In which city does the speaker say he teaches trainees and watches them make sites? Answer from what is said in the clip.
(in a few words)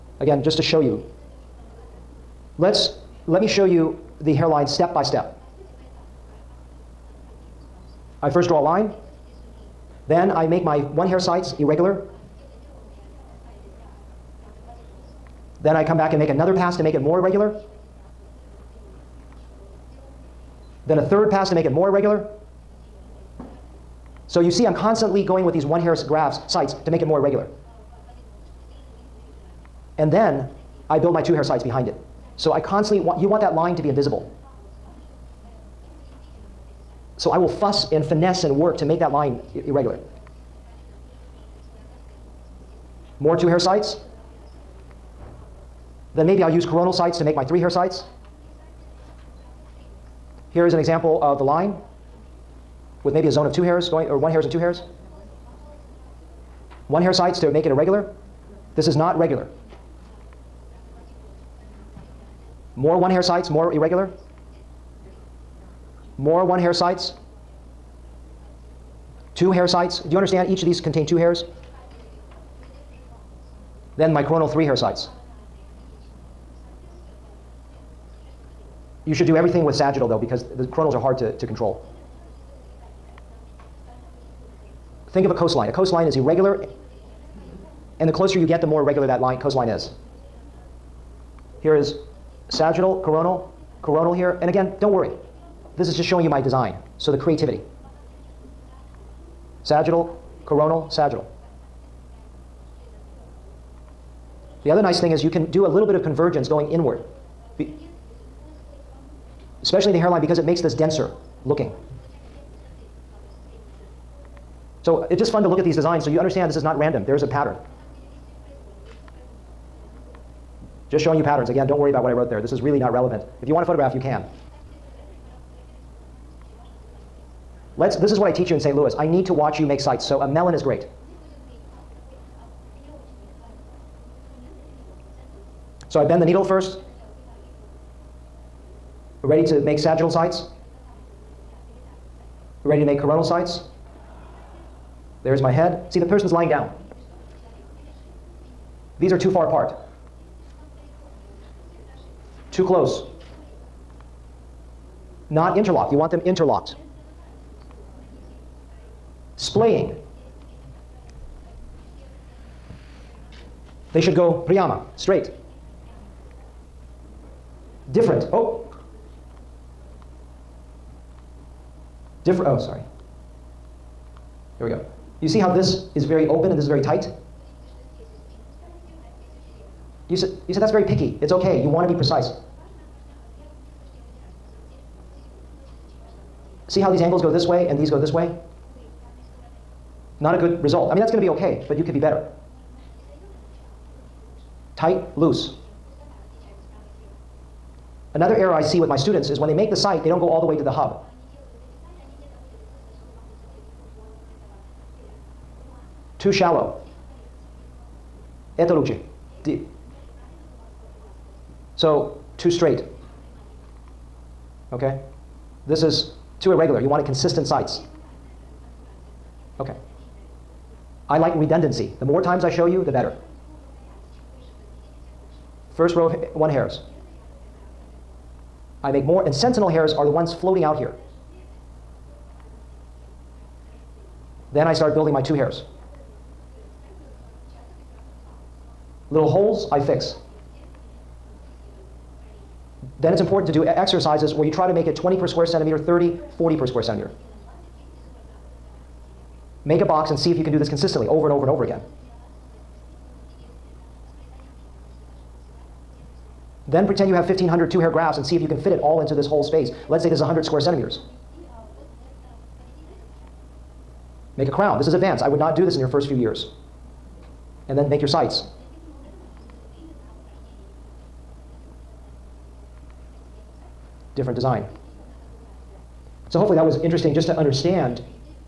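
St. Louis.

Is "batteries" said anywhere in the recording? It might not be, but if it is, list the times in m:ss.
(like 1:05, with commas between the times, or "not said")
not said.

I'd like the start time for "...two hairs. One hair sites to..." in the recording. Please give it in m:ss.
0:54.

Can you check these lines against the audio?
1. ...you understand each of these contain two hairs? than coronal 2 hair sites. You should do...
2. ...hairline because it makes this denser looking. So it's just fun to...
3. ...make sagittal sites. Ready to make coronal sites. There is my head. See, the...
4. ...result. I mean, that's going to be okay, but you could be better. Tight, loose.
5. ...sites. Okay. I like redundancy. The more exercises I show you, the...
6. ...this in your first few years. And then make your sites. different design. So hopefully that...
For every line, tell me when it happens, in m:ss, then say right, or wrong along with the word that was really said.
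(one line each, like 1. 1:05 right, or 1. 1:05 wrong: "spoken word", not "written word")
1. 1:10 wrong: "3", not "2"
2. 1:49 right
3. 2:19 right
4. 3:10 right
5. 3:37 wrong: "times", not "exercises"
6. 4:25 right.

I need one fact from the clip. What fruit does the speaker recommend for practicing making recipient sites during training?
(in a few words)
Melon.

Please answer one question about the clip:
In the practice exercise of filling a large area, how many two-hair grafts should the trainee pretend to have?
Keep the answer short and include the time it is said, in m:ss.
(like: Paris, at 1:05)
1,500, at 4:17.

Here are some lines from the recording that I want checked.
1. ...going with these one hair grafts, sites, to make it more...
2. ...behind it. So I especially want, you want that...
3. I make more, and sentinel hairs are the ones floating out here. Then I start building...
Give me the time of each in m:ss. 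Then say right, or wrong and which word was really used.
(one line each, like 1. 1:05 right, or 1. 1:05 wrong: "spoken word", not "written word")
1. 0:25 right
2. 0:31 wrong: "constantly", not "especially"
3. 3:48 right.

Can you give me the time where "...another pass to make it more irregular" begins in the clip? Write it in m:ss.
0:16.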